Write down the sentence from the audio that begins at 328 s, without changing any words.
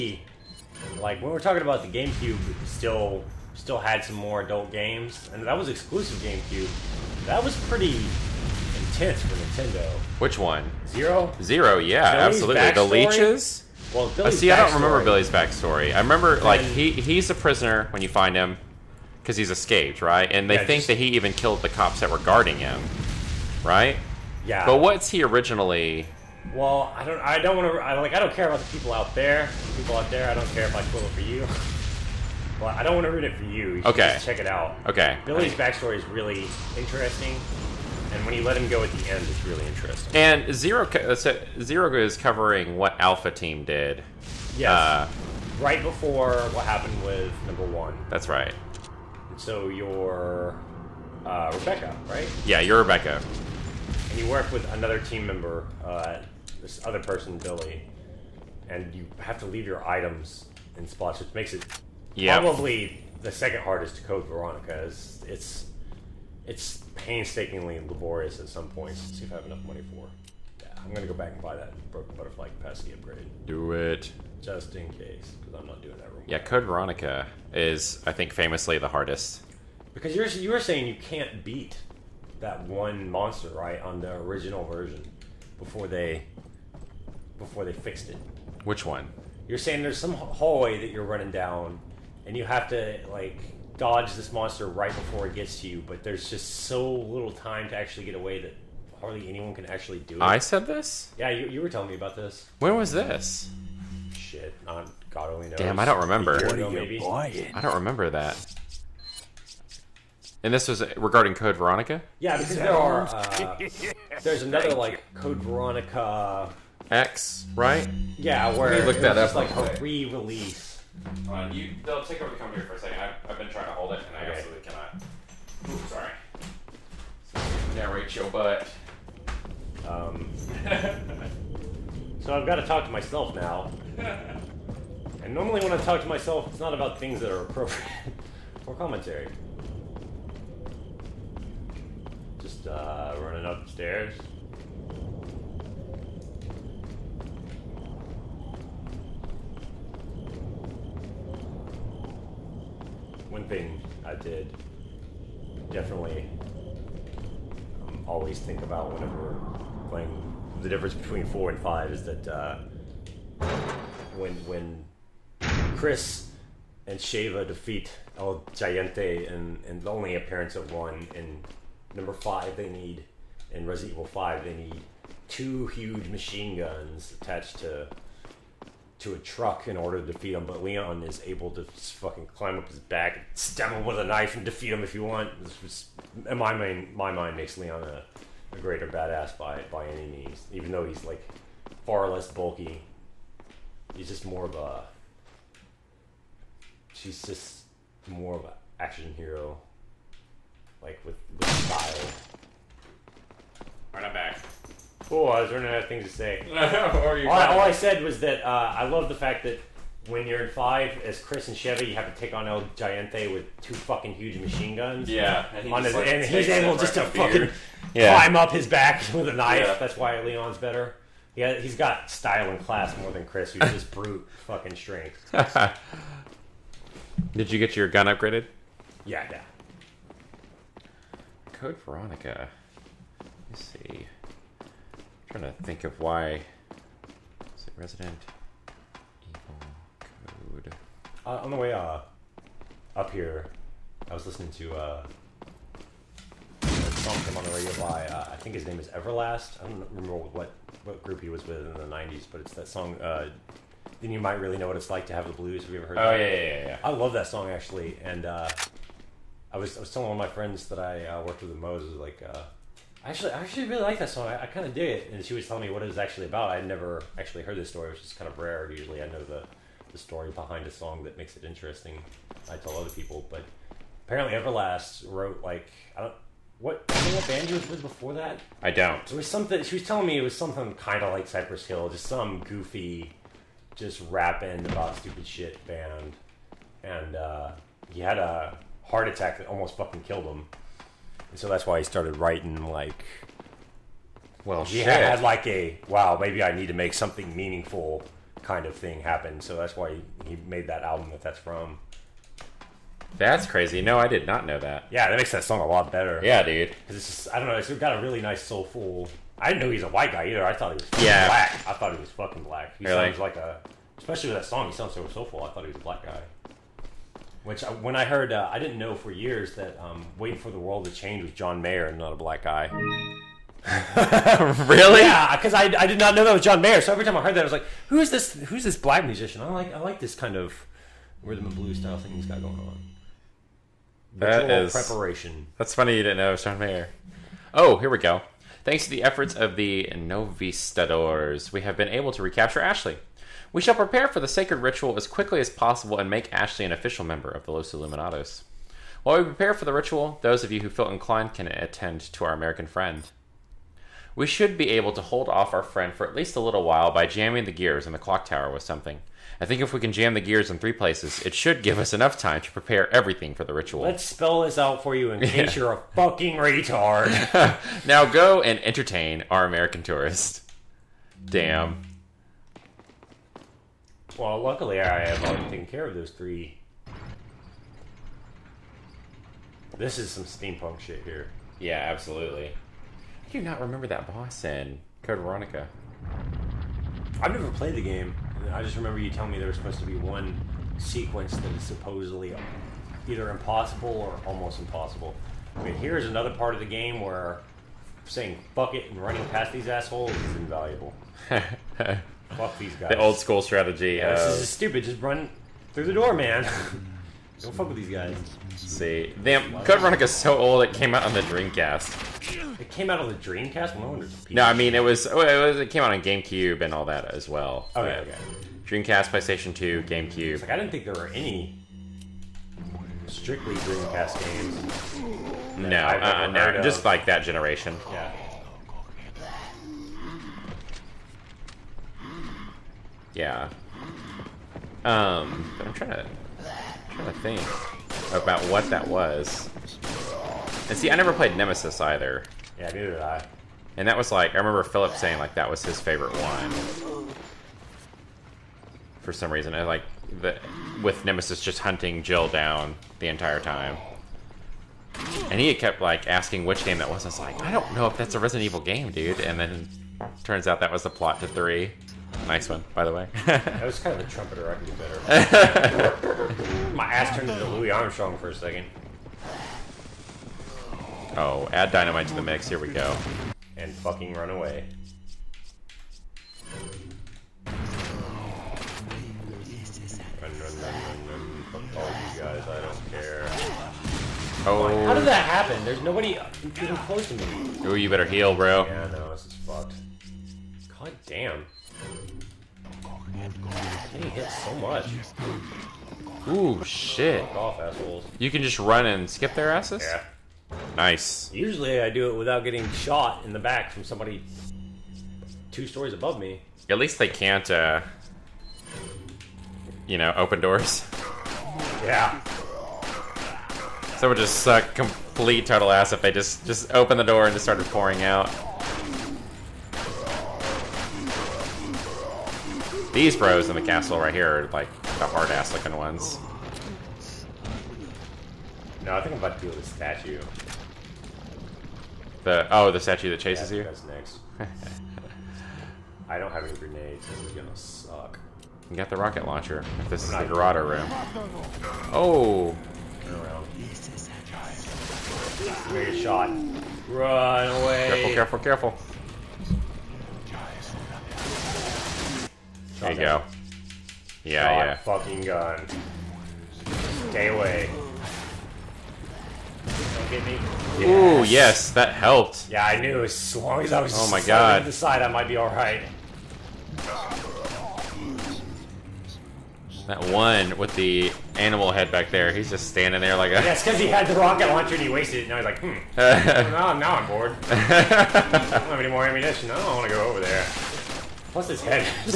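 Who's this black musician?" I like I like this kind of rhythm and blues style thing he's got going on.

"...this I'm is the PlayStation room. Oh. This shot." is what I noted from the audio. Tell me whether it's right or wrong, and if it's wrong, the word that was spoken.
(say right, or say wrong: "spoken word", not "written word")
wrong: "Dorado", not "PlayStation".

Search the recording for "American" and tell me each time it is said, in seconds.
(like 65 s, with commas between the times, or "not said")
352 s, 369 s.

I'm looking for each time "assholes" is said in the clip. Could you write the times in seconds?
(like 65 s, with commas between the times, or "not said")
399 s, 497 s.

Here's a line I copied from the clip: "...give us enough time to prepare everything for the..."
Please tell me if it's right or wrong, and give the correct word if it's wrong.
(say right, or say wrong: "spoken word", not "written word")
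right.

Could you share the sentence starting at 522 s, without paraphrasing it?
These bros in the castle right here are like the hard ass looking ones.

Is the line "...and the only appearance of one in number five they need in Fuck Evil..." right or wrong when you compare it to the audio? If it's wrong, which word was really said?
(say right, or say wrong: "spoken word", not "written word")
wrong: "Resident", not "Fuck".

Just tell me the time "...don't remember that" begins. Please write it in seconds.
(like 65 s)
107 s.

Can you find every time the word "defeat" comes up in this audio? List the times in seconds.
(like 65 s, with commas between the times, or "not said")
167 s, 180 s, 184 s.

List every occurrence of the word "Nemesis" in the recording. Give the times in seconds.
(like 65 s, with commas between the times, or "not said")
441 s, 451 s.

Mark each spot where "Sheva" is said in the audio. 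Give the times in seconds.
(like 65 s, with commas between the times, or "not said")
166 s, 211 s.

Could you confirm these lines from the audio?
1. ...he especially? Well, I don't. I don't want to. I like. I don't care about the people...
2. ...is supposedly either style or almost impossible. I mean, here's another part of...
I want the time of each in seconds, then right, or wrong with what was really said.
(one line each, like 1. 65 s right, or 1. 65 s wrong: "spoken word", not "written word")
1. 25 s wrong: "originally", not "especially"
2. 391 s wrong: "impossible", not "style".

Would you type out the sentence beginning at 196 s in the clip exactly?
She's just more of an action hero, like with, with style.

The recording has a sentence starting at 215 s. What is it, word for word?
Yeah, and, he on his, like and he's able just to fucking yeah.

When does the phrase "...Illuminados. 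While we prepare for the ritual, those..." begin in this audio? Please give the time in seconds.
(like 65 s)
347 s.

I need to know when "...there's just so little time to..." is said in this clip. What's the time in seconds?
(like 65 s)
96 s.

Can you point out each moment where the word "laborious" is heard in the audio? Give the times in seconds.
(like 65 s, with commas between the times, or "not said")
67 s.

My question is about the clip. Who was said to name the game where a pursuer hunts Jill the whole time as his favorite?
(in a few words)
Philip.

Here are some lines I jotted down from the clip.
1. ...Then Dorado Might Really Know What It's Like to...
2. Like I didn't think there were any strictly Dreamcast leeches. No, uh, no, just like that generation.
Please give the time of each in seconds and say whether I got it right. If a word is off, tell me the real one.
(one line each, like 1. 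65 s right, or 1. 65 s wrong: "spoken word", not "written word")
1. 254 s wrong: "You", not "Dorado"
2. 420 s wrong: "games", not "leeches".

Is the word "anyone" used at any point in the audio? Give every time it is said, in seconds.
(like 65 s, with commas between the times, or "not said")
99 s.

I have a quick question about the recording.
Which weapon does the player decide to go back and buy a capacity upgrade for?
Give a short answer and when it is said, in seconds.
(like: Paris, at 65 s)
broken butterfly, at 71 s.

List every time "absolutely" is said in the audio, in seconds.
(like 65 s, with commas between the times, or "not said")
12 s, 124 s, 381 s.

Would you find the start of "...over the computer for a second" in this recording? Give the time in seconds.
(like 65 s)
122 s.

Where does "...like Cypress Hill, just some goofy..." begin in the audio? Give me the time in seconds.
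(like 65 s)
281 s.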